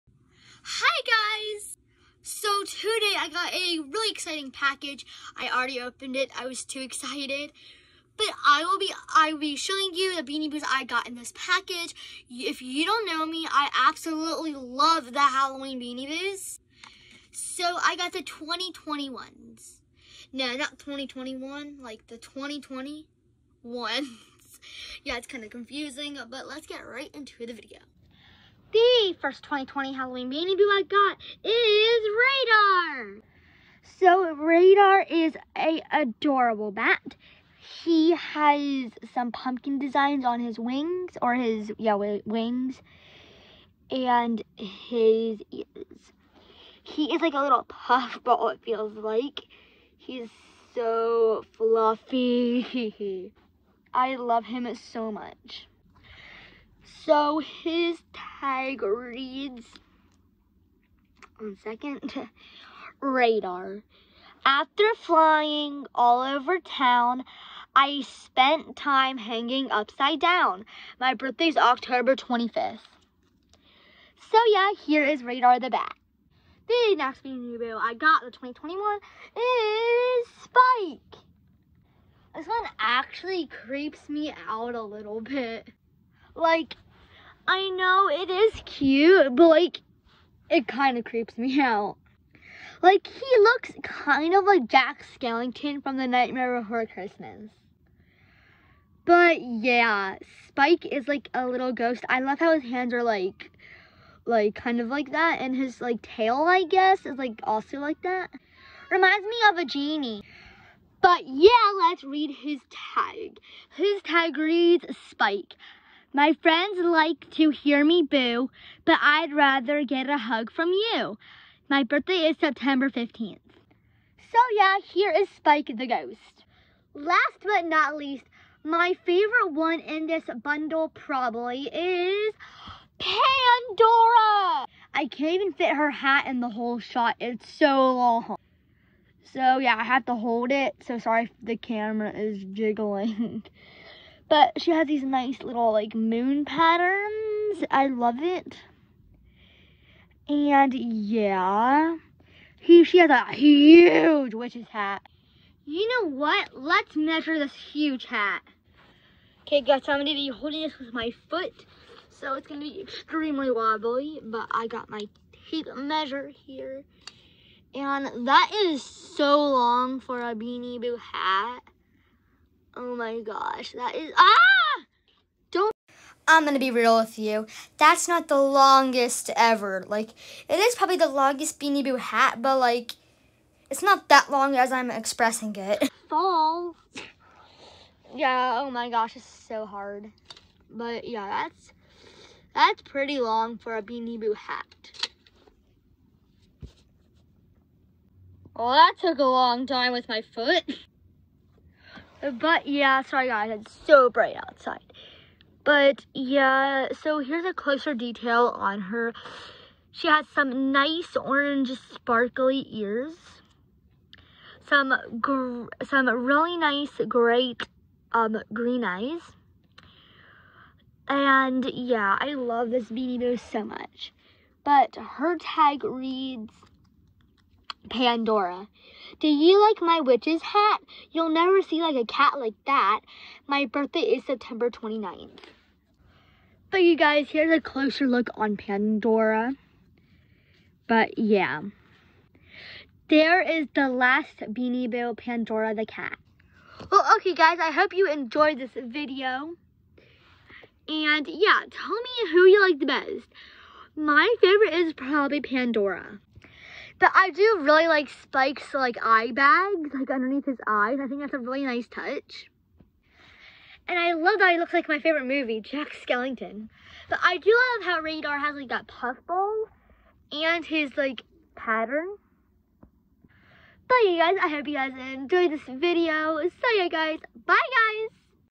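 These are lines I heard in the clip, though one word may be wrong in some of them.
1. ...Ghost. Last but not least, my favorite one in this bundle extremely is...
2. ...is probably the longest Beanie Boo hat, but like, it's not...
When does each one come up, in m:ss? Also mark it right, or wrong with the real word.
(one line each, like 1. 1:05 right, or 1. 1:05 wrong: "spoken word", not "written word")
1. 2:05 wrong: "probably", not "extremely"
2. 3:00 right.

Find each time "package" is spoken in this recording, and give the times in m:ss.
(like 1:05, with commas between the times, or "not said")
0:04, 0:11.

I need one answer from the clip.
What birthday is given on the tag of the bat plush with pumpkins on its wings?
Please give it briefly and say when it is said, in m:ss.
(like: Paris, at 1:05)
October 25th, at 1:11.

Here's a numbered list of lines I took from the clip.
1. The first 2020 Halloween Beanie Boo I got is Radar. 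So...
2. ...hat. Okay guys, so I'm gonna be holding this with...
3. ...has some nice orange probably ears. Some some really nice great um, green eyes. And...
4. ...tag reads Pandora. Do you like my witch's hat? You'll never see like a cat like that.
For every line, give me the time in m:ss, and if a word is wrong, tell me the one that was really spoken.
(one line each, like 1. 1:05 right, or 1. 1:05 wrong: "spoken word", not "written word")
1. 0:28 right
2. 2:38 right
3. 3:30 wrong: "sparkly", not "probably"
4. 3:45 right.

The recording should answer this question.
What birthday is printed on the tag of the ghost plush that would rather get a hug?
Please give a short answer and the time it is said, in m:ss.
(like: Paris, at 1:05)
September 15th, at 2:02.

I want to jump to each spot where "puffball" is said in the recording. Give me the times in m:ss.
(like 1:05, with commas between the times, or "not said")
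0:47, 4:28.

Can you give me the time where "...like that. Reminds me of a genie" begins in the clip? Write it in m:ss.
1:47.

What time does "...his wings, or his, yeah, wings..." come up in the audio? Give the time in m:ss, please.
0:40.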